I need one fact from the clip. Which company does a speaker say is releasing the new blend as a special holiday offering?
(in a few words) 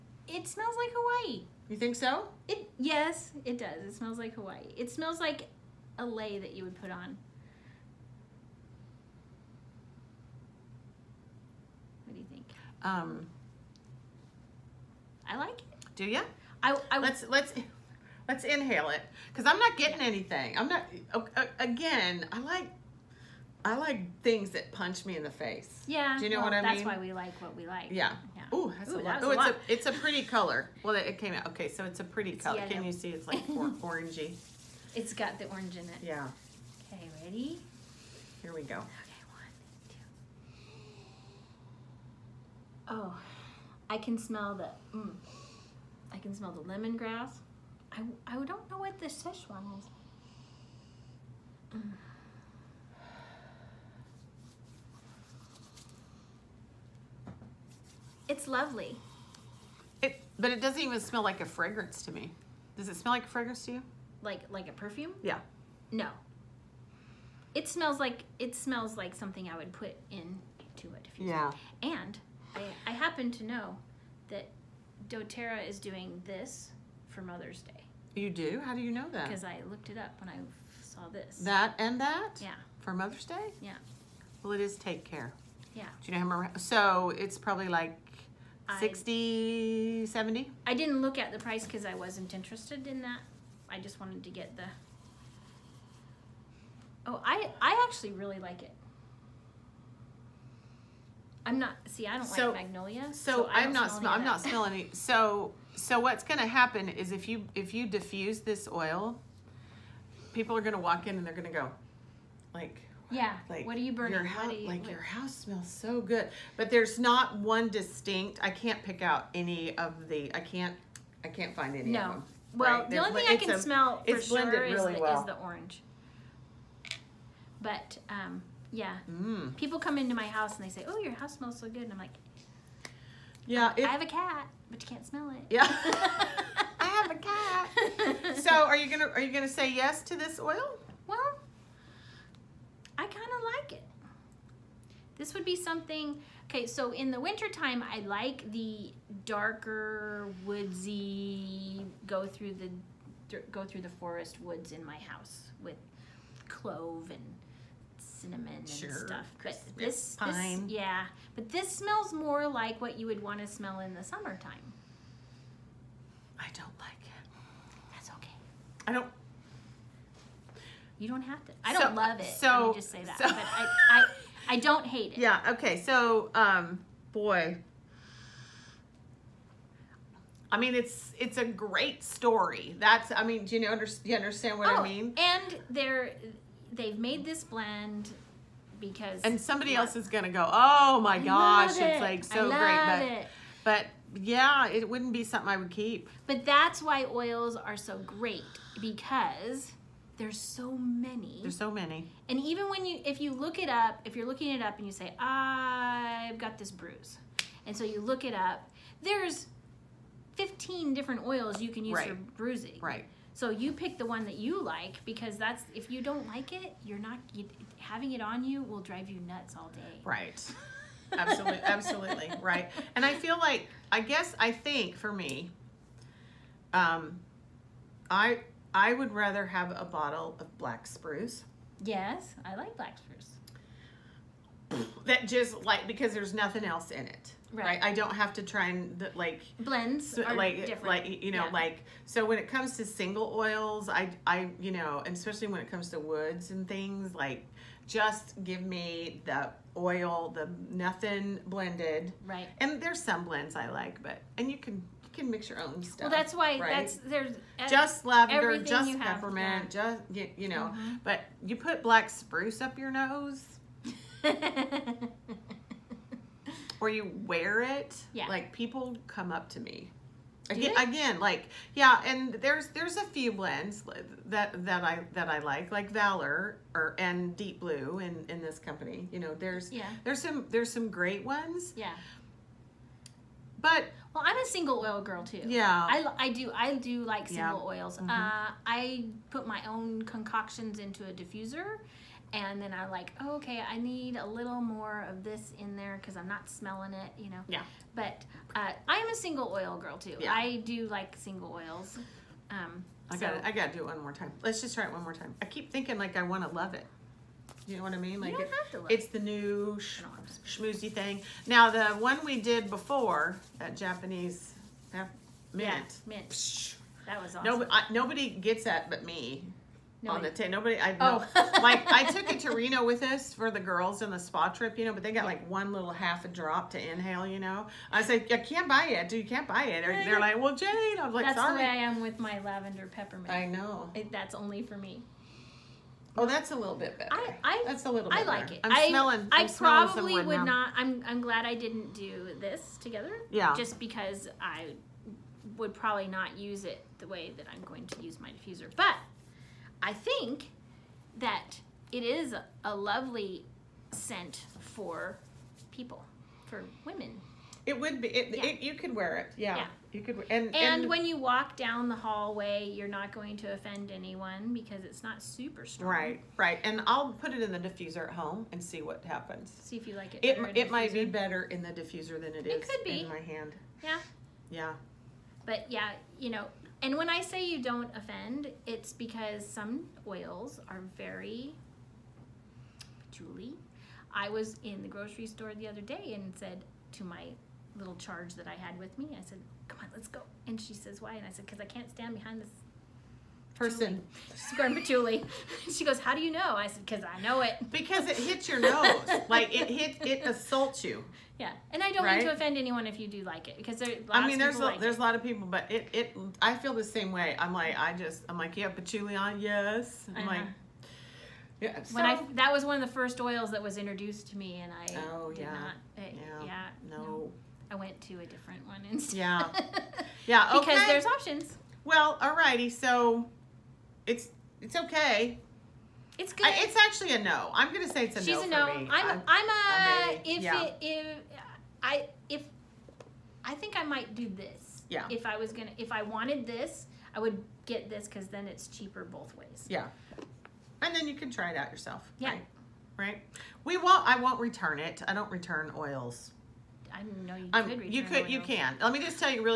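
DoTerra.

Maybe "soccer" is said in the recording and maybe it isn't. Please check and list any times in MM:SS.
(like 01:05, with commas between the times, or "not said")
not said.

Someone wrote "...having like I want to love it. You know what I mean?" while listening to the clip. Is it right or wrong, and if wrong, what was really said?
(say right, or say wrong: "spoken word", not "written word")
wrong: "thinking", not "having".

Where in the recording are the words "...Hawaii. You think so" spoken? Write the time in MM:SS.
00:00.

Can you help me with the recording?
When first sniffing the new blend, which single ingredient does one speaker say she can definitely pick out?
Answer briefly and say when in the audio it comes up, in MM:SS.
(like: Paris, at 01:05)
lemongrass, at 00:46.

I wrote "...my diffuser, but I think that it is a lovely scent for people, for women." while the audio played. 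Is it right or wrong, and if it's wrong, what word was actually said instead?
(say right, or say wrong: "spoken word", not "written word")
right.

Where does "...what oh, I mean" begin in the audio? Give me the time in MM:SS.
03:04.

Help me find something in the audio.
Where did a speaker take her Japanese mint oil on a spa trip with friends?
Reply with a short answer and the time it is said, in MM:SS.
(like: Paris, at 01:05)
Reno, at 05:22.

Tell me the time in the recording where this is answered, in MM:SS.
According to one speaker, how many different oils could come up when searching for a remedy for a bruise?
03:30.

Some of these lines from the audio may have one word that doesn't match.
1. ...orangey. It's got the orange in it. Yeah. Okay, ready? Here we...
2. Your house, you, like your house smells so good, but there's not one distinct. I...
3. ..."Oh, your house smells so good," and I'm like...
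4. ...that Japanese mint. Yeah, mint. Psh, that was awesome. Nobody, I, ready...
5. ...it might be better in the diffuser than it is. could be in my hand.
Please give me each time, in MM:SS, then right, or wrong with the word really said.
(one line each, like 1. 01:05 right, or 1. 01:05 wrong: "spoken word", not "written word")
1. 00:33 right
2. 01:54 right
3. 02:10 right
4. 05:13 wrong: "nobody", not "ready"
5. 06:10 right.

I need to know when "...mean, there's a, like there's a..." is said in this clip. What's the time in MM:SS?
06:44.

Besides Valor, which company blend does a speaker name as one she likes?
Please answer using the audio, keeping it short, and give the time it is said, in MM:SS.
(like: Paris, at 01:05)
Deep Blue, at 04:37.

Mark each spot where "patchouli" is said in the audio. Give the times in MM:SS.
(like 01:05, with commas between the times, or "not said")
06:23, 06:34, 06:48.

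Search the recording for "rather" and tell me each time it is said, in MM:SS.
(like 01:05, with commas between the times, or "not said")
03:49.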